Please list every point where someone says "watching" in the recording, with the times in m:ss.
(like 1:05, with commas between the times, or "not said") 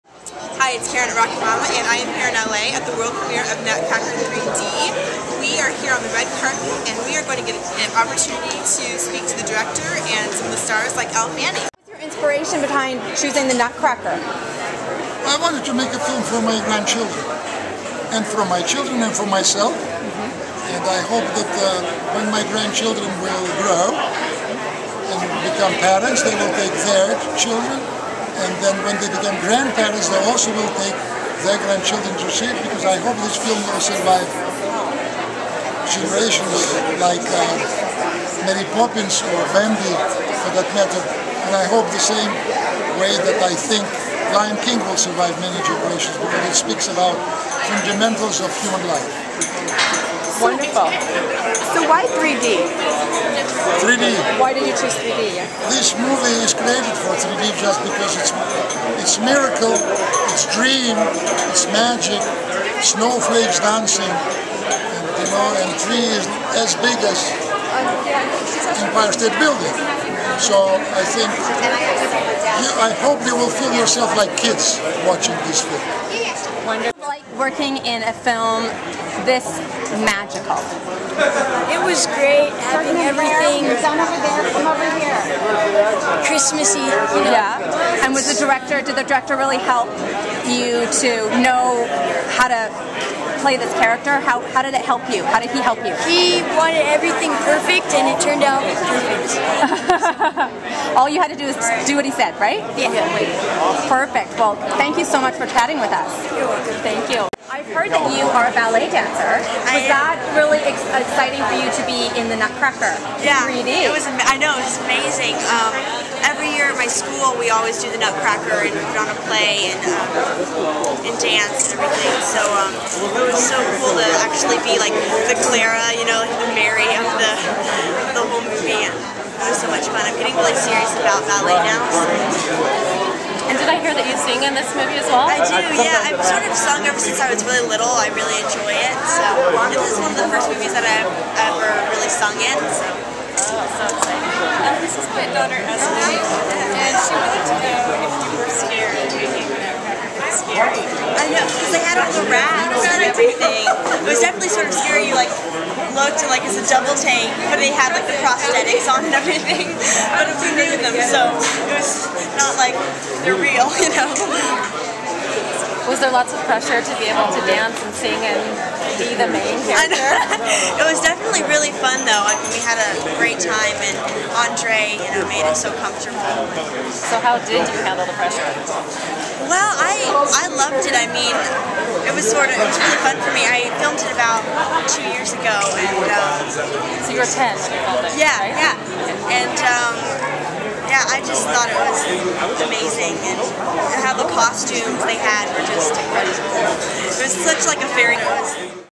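1:15.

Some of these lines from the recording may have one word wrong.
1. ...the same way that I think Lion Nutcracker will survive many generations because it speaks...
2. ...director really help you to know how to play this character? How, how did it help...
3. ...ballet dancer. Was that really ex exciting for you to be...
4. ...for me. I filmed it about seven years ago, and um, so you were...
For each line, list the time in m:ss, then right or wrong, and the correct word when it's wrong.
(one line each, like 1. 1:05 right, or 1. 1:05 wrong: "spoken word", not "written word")
1. 0:41 wrong: "King", not "Nutcracker"
2. 1:29 right
3. 1:48 right
4. 3:03 wrong: "two", not "seven".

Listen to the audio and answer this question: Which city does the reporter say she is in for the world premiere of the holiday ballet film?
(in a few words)
LA.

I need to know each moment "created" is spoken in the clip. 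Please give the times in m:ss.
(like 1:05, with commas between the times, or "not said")
0:56.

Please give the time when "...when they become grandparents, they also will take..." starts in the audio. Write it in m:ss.
0:28.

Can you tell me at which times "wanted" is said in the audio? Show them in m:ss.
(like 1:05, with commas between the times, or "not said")
0:15, 1:36.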